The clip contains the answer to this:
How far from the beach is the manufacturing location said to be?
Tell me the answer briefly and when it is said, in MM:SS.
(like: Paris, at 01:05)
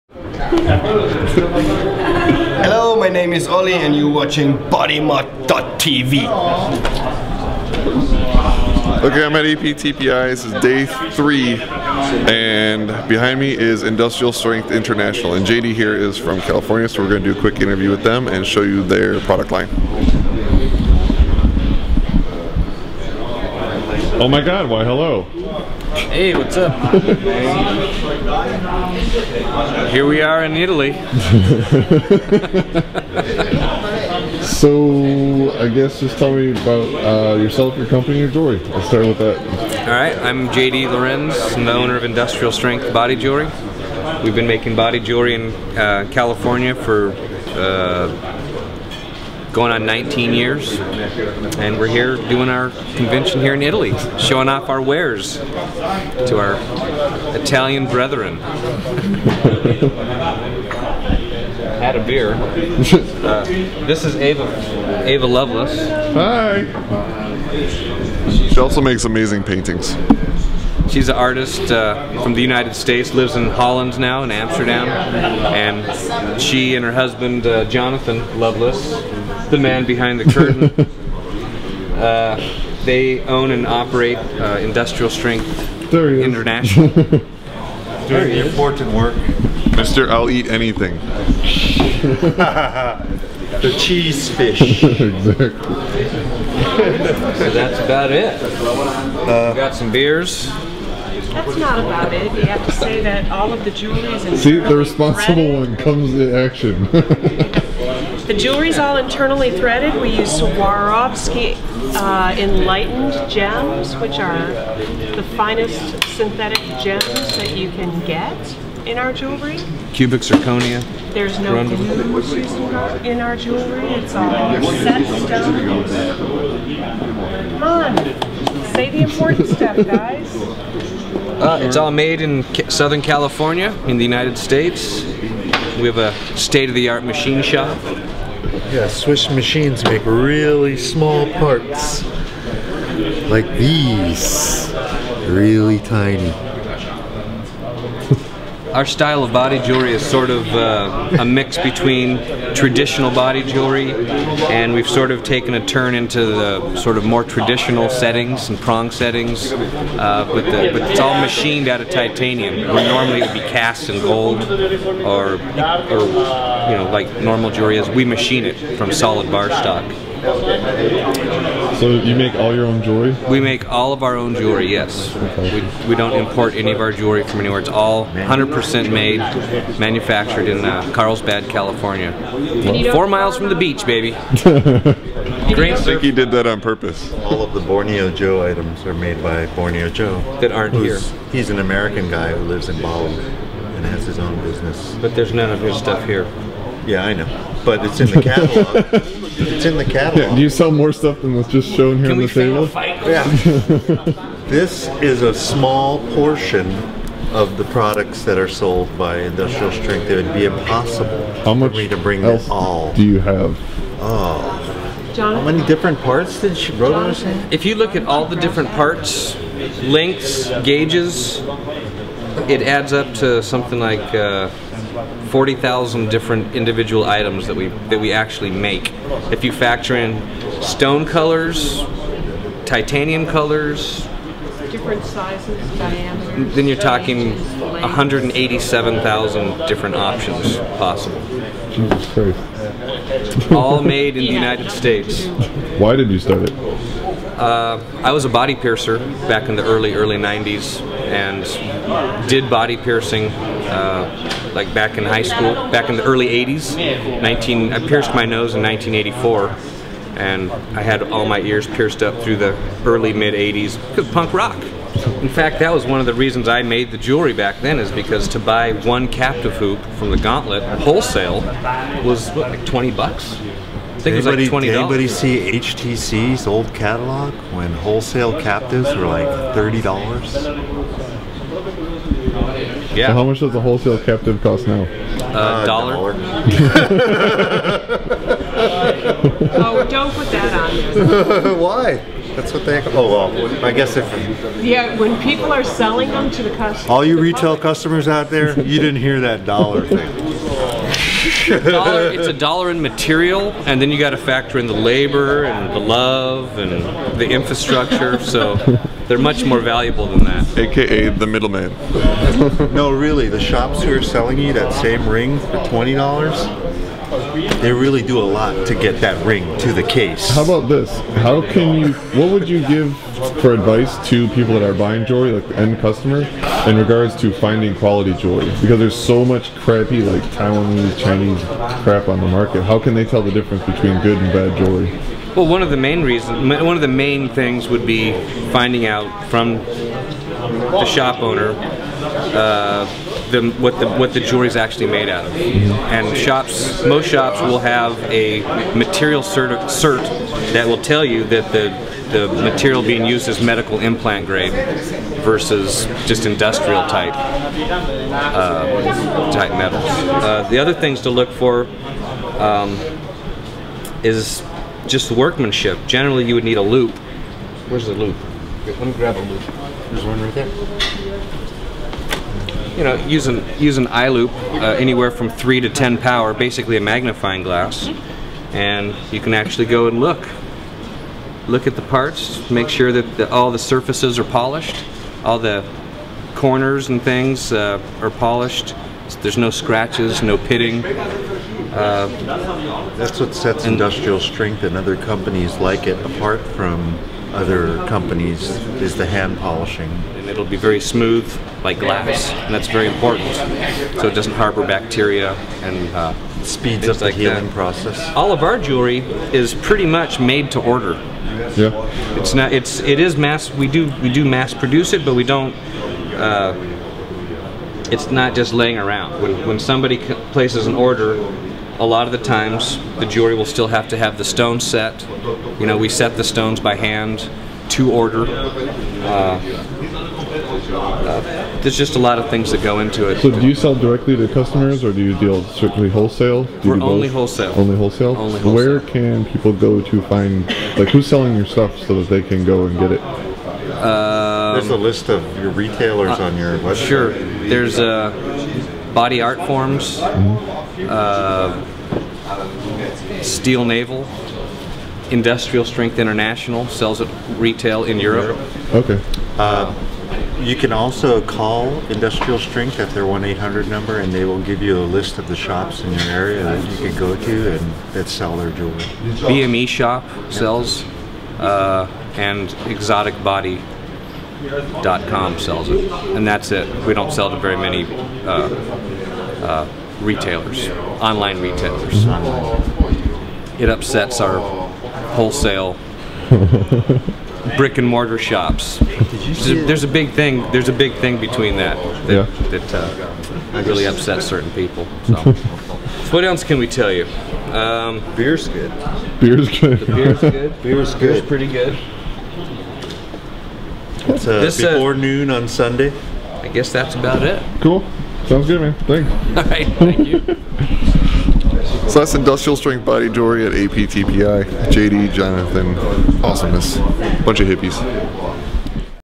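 4 miles, at 03:02.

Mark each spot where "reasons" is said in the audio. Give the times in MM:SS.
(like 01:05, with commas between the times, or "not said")
04:26, 05:36.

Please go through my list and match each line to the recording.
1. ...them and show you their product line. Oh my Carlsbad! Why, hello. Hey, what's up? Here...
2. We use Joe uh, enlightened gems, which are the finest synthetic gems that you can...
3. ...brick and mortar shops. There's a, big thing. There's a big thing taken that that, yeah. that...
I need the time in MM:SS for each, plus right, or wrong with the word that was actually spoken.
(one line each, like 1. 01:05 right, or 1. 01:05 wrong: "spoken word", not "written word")
1. 00:18 wrong: "God", not "Carlsbad"
2. 01:50 wrong: "Swarovski", not "Joe"
3. 08:07 wrong: "between", not "taken".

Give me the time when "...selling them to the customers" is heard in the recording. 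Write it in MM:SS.
04:55.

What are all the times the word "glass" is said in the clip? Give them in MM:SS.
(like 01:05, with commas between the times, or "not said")
06:17, 06:41.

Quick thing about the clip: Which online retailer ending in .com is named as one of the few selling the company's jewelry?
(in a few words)
exoticbody.com.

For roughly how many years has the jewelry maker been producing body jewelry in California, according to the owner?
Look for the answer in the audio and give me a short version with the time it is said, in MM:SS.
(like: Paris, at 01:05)
19, at 00:49.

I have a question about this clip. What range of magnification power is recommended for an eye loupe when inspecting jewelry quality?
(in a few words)
3 to 10.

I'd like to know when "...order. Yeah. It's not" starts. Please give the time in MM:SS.
06:50.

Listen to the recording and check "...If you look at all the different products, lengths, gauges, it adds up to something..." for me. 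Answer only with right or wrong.
wrong.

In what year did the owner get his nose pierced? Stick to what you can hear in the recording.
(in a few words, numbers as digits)
1984.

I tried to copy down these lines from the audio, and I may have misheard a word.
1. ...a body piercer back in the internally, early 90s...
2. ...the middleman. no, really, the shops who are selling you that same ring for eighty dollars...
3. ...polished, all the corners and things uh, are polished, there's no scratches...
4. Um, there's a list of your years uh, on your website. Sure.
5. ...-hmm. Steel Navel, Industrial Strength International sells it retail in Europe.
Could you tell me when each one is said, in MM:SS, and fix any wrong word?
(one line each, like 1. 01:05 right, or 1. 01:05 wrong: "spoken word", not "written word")
1. 04:08 wrong: "early", not "internally"
2. 05:11 wrong: "twenty", not "eighty"
3. 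06:24 right
4. 07:23 wrong: "retailers", not "years"
5. 07:30 right.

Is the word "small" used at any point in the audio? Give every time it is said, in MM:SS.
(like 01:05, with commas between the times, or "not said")
02:20, 03:25.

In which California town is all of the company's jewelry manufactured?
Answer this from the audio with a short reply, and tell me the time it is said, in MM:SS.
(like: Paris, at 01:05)
Carlsbad, at 03:00.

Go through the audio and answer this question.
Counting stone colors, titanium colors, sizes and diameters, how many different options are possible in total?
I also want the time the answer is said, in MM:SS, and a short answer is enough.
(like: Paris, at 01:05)
187,000, at 03:57.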